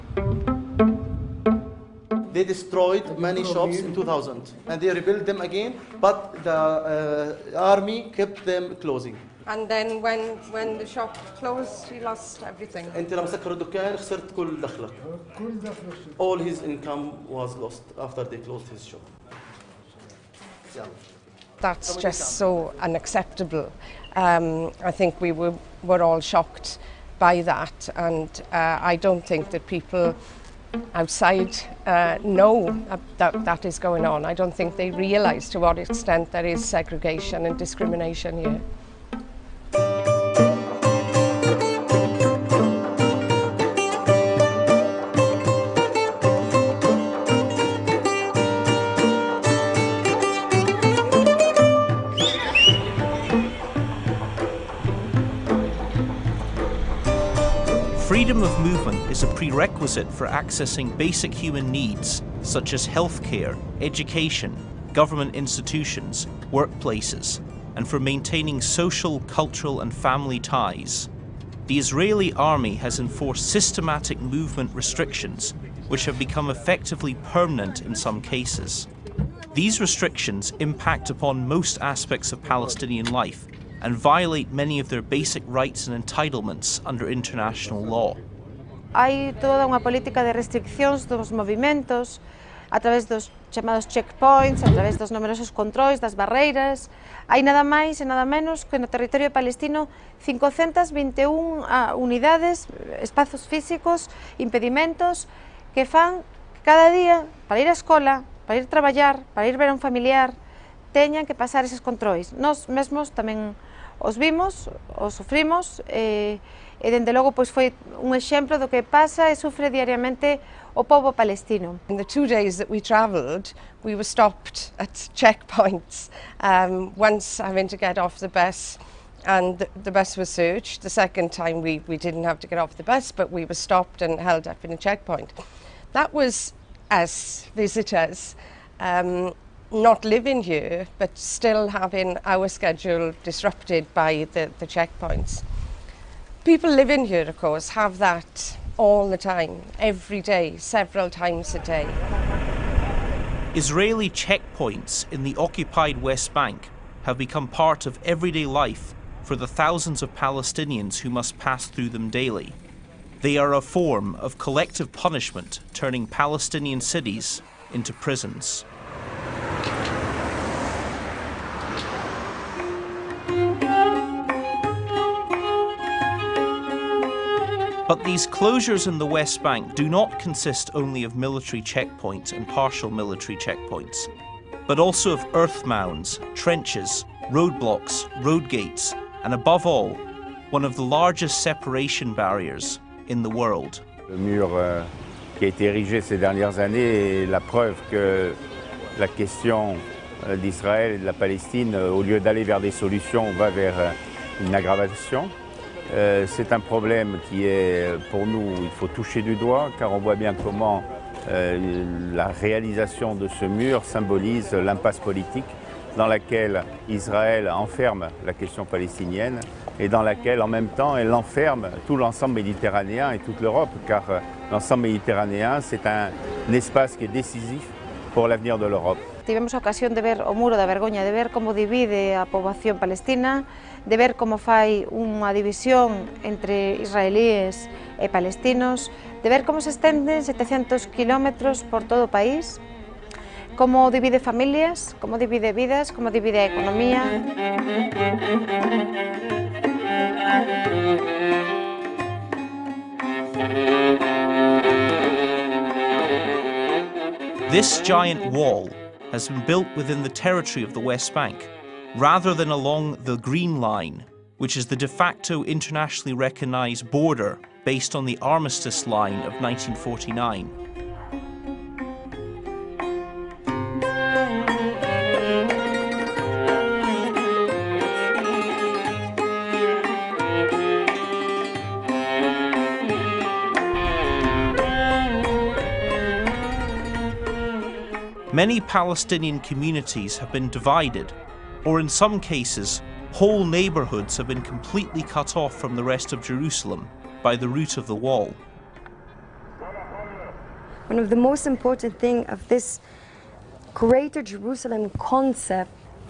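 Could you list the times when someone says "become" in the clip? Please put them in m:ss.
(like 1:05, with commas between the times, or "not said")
1:16, 2:37.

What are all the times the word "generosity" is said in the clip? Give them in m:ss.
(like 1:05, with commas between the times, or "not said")
not said.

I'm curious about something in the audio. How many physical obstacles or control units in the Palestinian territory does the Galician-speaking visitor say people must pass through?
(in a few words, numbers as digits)
521.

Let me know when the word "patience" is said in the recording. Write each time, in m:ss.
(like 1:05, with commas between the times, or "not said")
not said.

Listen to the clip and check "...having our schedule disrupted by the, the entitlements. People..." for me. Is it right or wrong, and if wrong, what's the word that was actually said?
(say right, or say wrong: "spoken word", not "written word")
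wrong: "checkpoints", not "entitlements".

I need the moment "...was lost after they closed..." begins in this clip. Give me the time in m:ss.
0:17.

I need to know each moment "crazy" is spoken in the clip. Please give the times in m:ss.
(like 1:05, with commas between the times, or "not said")
not said.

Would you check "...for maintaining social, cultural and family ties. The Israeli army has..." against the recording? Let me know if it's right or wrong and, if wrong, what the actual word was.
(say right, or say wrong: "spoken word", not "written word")
right.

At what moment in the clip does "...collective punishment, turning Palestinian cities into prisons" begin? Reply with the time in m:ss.
2:44.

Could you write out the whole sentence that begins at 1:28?
Hay toda unha política de de dos movimientos a través dos chamados checkpoints, a través dos numerosos controis, das barreiras.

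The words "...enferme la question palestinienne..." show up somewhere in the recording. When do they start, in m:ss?
3:37.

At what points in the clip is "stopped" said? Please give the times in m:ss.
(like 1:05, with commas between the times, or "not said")
2:04, 2:13.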